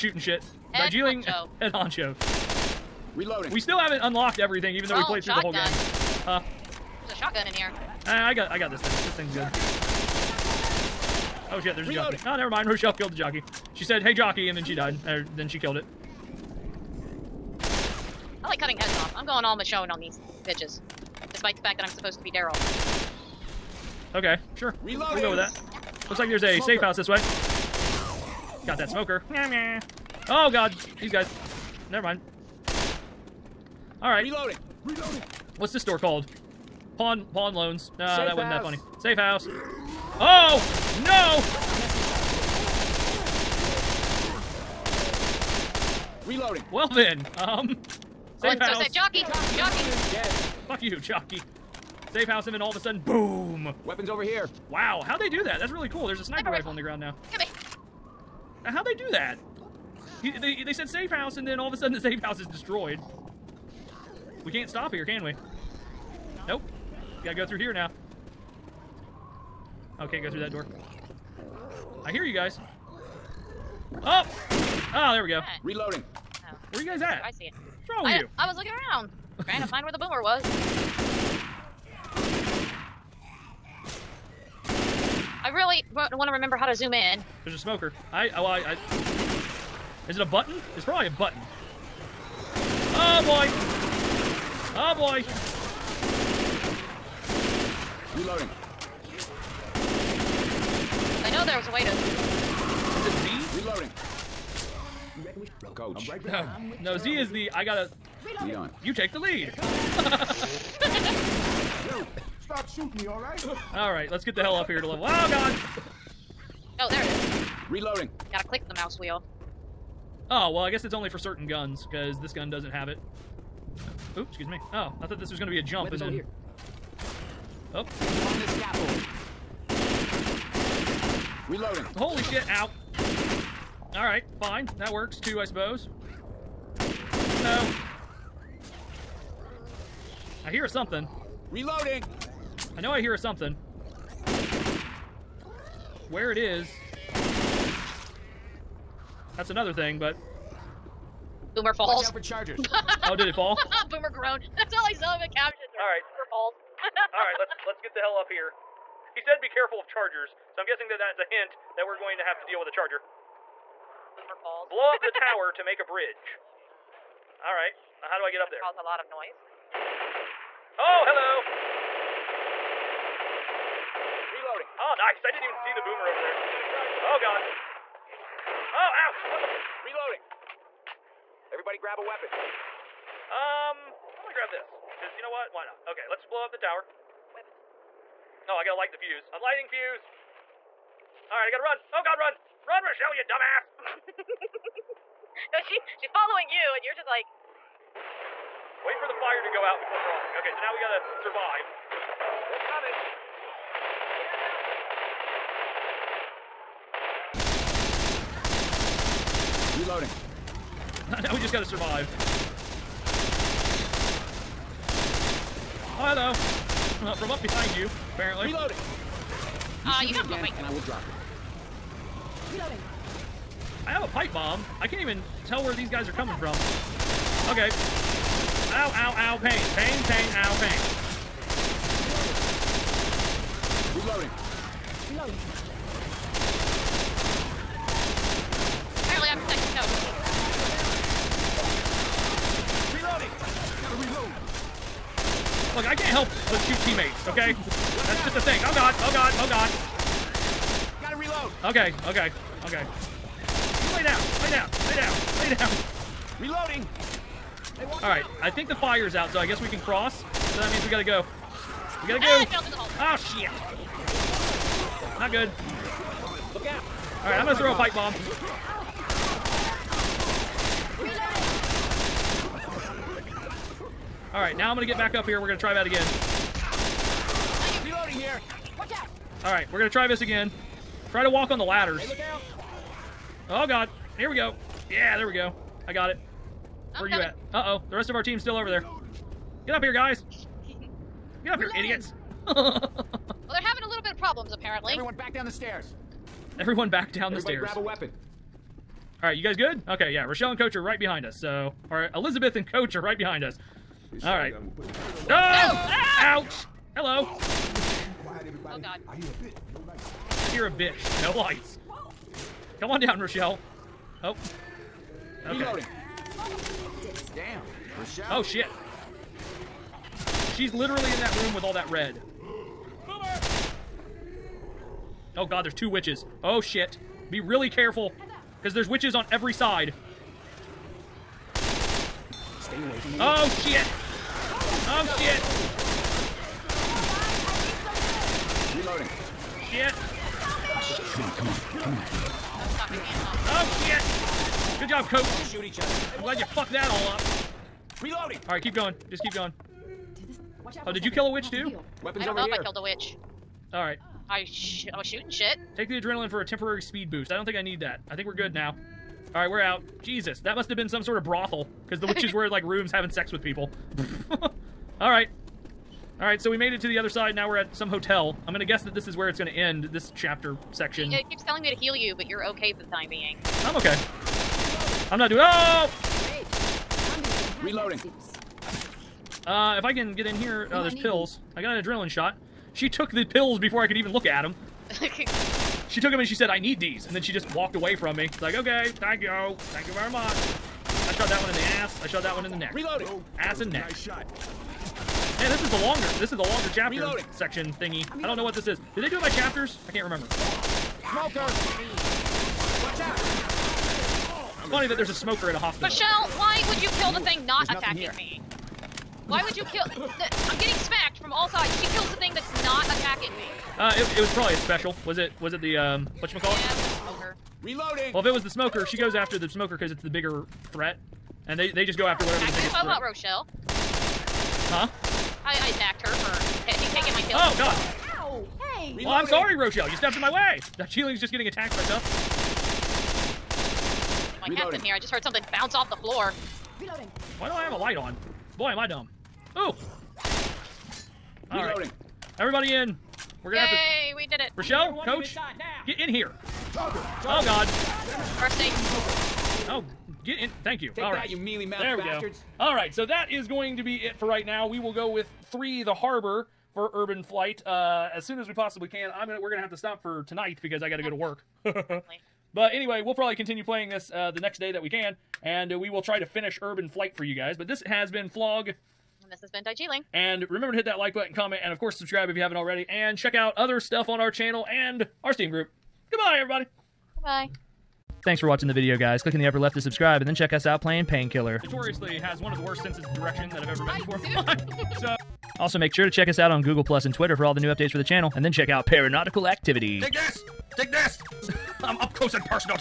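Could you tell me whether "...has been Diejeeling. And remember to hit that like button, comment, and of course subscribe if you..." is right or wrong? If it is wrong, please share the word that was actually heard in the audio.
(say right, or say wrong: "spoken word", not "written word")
right.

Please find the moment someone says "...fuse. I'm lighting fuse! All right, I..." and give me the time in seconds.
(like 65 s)
188 s.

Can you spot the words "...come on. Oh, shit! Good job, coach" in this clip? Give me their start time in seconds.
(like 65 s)
341 s.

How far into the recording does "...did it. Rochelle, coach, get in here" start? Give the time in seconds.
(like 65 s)
444 s.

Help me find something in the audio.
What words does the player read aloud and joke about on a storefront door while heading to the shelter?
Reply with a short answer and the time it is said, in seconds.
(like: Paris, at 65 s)
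Pawn loans, at 36 s.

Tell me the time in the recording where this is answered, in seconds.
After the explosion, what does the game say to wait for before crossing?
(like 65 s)
199 s.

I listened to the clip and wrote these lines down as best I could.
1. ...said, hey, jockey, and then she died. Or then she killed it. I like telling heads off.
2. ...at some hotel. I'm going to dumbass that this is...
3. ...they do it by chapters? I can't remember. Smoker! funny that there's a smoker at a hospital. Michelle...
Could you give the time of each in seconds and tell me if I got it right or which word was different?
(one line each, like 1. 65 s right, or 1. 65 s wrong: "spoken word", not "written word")
1. 13 s wrong: "cutting", not "telling"
2. 367 s wrong: "guess", not "dumbass"
3. 399 s right.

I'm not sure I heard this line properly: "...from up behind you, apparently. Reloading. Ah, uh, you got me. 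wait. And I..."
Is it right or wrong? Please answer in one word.
right.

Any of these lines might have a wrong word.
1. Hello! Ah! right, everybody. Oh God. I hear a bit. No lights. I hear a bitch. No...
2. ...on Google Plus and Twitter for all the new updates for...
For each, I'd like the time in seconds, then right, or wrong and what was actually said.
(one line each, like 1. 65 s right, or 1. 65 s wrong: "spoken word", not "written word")
1. 306 s right
2. 486 s right.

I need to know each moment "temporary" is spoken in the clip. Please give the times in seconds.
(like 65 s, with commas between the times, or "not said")
356 s.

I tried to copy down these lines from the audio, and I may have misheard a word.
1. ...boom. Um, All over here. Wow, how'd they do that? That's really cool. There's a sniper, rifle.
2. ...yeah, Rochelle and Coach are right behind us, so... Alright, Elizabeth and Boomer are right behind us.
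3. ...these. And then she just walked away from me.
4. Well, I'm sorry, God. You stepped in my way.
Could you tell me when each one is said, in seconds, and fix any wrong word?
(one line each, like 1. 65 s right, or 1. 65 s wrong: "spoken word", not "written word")
1. 53 s wrong: "Weapons", not "All"
2. 300 s wrong: "Coach", not "Boomer"
3. 386 s right
4. 429 s wrong: "Rochelle", not "God".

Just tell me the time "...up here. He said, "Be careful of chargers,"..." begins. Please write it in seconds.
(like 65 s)
158 s.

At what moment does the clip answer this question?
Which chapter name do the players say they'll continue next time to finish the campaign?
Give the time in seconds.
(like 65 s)
455 s.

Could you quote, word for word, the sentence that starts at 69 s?
Okay, oh, go through that door.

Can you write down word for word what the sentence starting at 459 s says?
I'm gonna we're gonna have to stop for tonight because I got to go to work.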